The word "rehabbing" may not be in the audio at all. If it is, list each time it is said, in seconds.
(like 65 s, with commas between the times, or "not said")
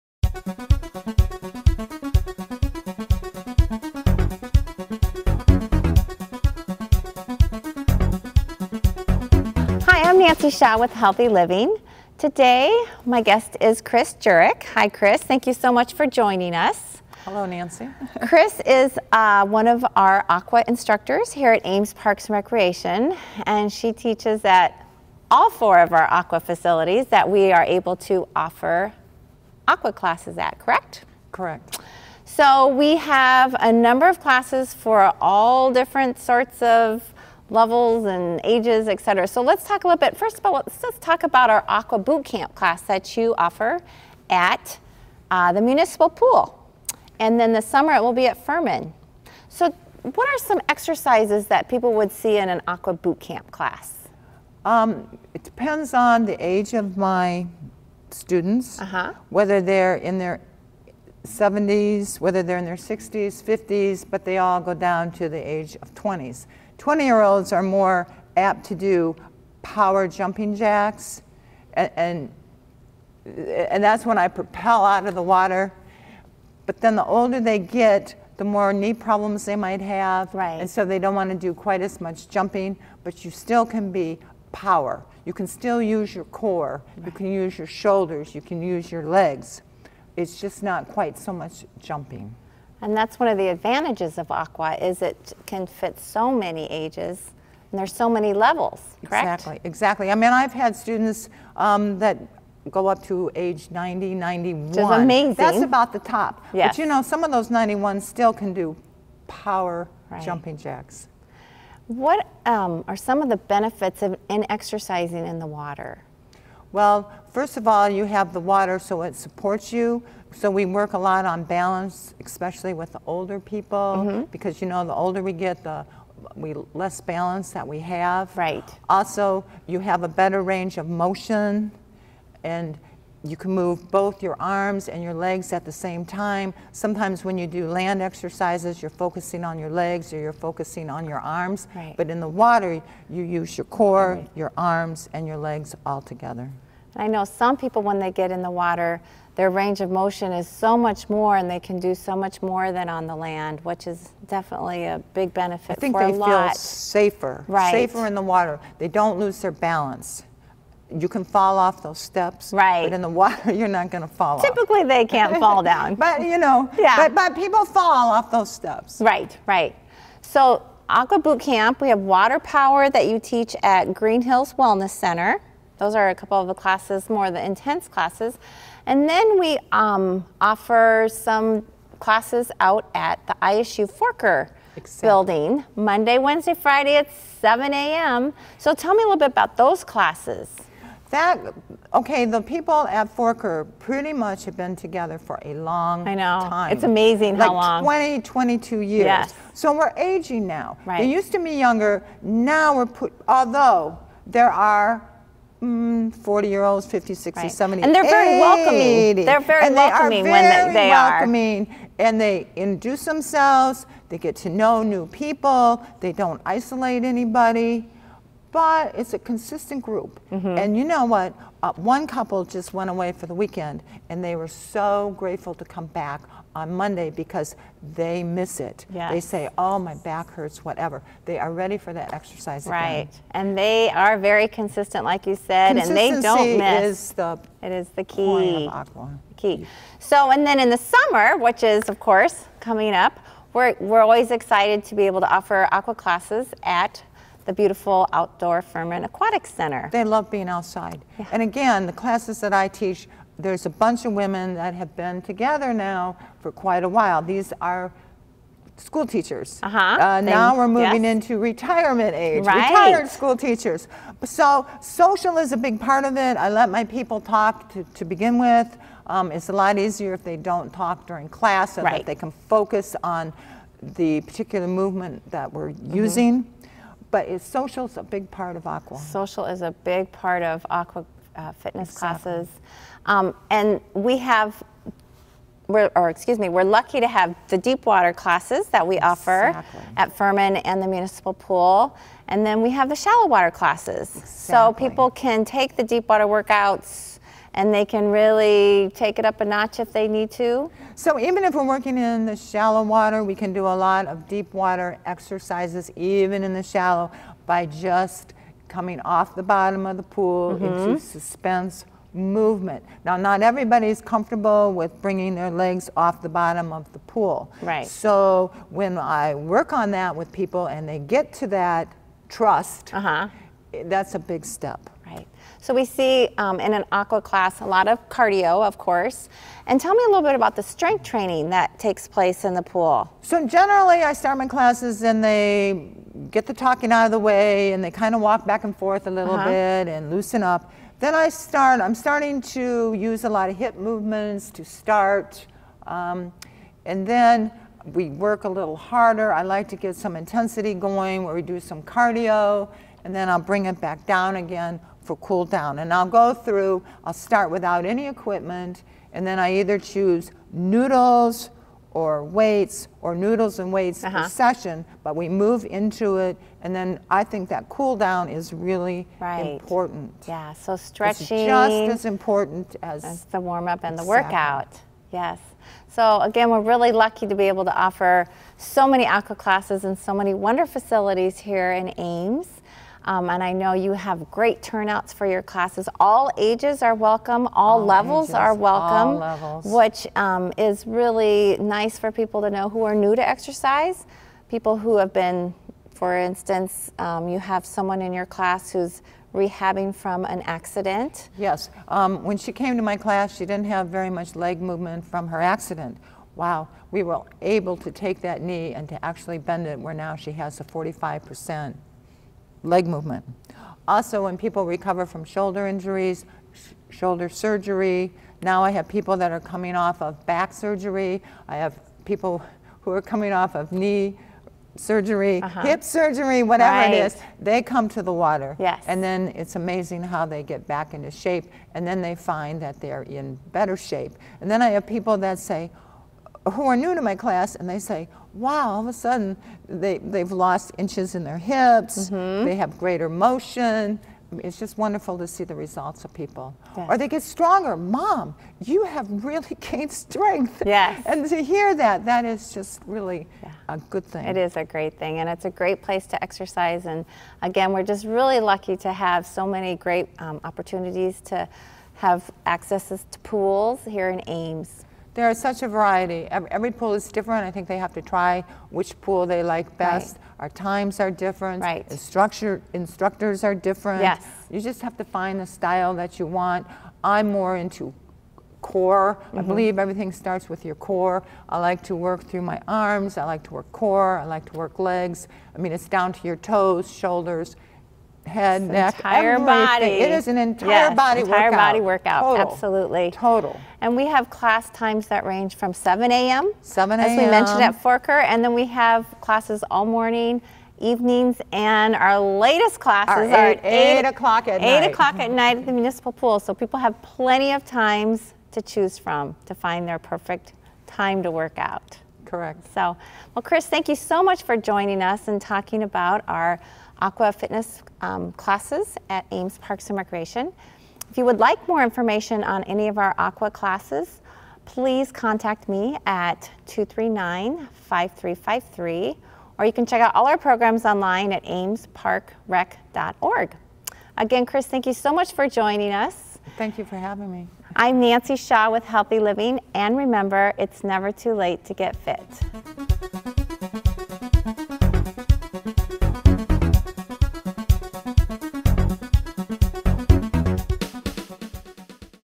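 399 s.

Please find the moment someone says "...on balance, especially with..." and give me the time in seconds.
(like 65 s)
121 s.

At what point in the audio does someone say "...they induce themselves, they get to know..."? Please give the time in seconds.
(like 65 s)
212 s.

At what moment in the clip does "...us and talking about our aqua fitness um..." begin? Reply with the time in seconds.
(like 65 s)
515 s.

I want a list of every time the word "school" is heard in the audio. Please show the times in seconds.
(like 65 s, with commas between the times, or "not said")
258 s, 263 s.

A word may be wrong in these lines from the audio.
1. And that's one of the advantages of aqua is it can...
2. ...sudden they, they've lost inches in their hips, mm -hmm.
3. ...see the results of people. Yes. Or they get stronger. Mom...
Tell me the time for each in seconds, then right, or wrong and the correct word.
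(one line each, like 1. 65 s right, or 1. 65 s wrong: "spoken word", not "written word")
1. 92 s right
2. 438 s right
3. 445 s right.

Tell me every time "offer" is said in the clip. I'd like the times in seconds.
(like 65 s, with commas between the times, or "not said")
28 s, 43 s, 180 s, 245 s, 288 s, 377 s.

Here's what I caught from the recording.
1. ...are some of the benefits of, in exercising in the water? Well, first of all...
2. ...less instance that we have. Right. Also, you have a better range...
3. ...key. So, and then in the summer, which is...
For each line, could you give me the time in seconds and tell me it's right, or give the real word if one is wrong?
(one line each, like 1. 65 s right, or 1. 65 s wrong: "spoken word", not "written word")
1. 112 s right
2. 126 s wrong: "balance", not "instance"
3. 239 s right.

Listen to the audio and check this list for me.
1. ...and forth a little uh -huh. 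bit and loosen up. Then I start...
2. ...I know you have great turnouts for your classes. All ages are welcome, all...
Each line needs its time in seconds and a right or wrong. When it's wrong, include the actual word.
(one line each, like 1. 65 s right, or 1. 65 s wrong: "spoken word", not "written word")
1. 338 s right
2. 383 s right.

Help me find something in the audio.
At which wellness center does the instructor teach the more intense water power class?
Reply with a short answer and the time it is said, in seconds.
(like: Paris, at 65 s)
Green Hills Wellness Center, at 173 s.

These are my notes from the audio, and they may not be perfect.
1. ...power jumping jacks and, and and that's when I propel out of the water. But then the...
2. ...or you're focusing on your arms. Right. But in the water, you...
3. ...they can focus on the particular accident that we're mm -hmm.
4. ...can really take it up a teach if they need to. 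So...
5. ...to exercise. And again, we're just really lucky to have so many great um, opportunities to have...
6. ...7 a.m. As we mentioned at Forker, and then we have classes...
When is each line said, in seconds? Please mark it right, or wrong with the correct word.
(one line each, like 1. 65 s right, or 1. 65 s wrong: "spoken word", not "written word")
1. 69 s right
2. 140 s right
3. 272 s wrong: "movement", not "accident"
4. 297 s wrong: "notch", not "teach"
5. 456 s right
6. 496 s right.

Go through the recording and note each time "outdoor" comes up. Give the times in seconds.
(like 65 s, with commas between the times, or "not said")
248 s.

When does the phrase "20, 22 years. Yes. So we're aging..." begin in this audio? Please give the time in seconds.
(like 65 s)
197 s.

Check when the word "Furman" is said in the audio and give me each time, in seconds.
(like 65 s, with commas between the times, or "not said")
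48 s, 248 s, 290 s.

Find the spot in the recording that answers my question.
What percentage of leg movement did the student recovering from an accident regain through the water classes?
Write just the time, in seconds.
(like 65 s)
410 s.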